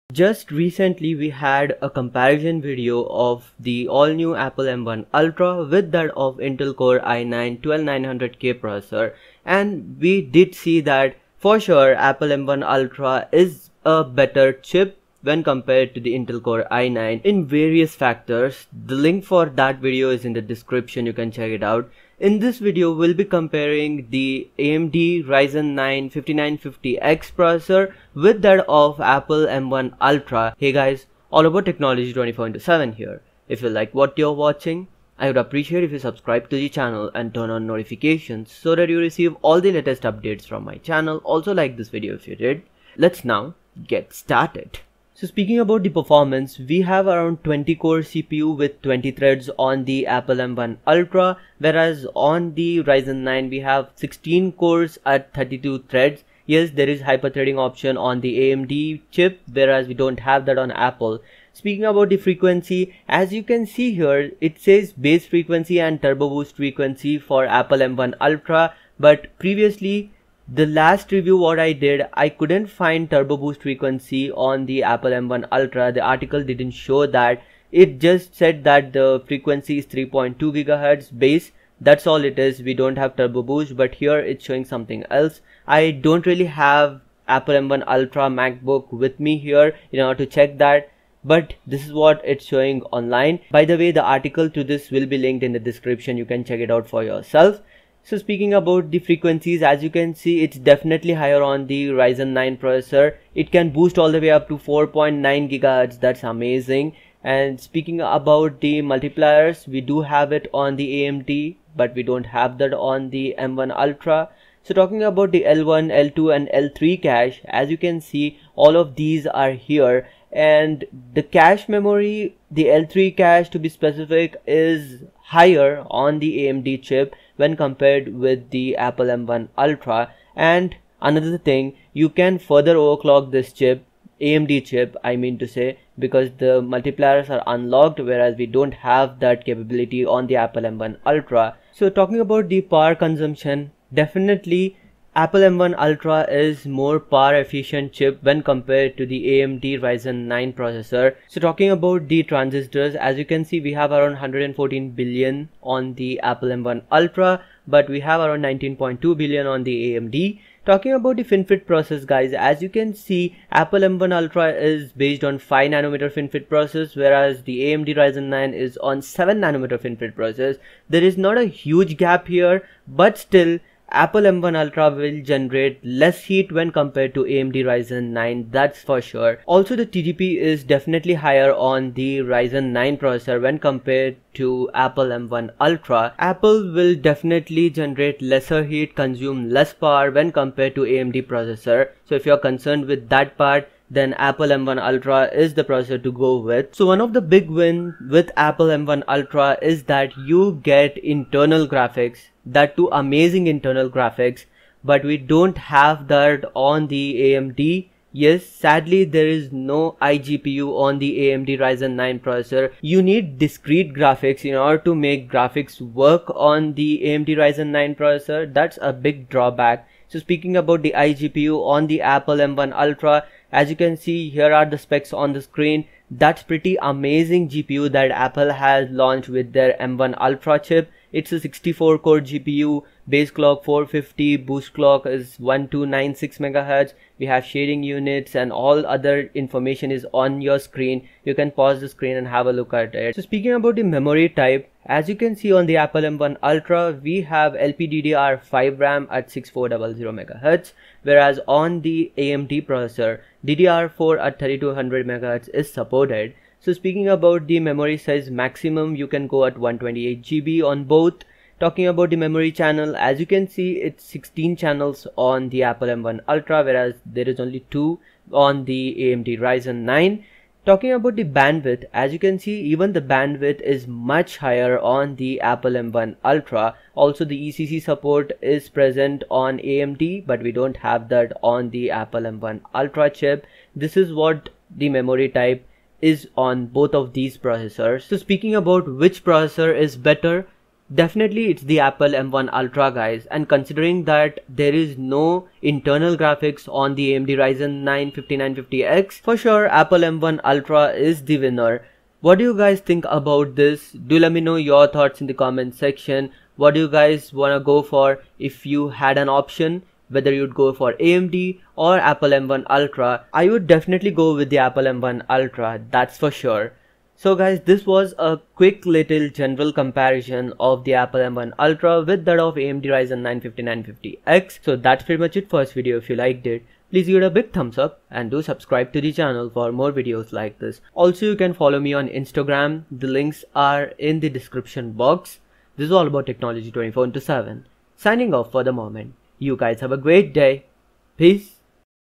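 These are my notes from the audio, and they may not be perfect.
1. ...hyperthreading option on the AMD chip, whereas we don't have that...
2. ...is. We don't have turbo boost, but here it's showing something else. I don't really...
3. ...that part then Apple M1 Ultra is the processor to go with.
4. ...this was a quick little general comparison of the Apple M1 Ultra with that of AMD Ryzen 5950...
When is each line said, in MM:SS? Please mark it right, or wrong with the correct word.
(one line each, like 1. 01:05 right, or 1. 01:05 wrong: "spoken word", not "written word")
1. 00:57 right
2. 01:22 right
3. 03:13 right
4. 05:17 right.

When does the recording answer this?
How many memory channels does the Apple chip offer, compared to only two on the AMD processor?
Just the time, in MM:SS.
04:24.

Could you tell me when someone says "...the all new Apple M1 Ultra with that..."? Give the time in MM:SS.
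00:03.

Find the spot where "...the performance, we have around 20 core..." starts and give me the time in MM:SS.
00:45.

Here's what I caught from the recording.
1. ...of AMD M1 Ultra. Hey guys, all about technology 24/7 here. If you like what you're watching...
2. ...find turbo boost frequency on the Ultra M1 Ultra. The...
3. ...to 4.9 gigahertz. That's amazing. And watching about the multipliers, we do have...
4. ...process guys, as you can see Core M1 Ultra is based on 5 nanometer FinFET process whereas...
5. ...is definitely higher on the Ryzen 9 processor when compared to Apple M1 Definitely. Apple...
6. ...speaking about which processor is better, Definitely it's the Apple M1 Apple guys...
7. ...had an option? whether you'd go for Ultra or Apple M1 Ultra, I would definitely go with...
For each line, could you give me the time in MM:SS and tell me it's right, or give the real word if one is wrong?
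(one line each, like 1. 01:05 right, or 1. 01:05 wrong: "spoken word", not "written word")
1. 00:28 wrong: "Apple", not "AMD"
2. 01:12 wrong: "Apple", not "Ultra"
3. 01:44 wrong: "speaking", not "watching"
4. 02:41 wrong: "Apple", not "Core"
5. 03:00 wrong: "Ultra", not "Definitely"
6. 04:48 wrong: "Ultra", not "Apple"
7. 05:08 wrong: "AMD", not "Ultra".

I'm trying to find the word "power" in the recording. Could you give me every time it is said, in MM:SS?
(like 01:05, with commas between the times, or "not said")
02:22, 02:26, 03:09.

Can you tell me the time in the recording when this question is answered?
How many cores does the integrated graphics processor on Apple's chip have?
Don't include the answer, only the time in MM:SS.
03:51.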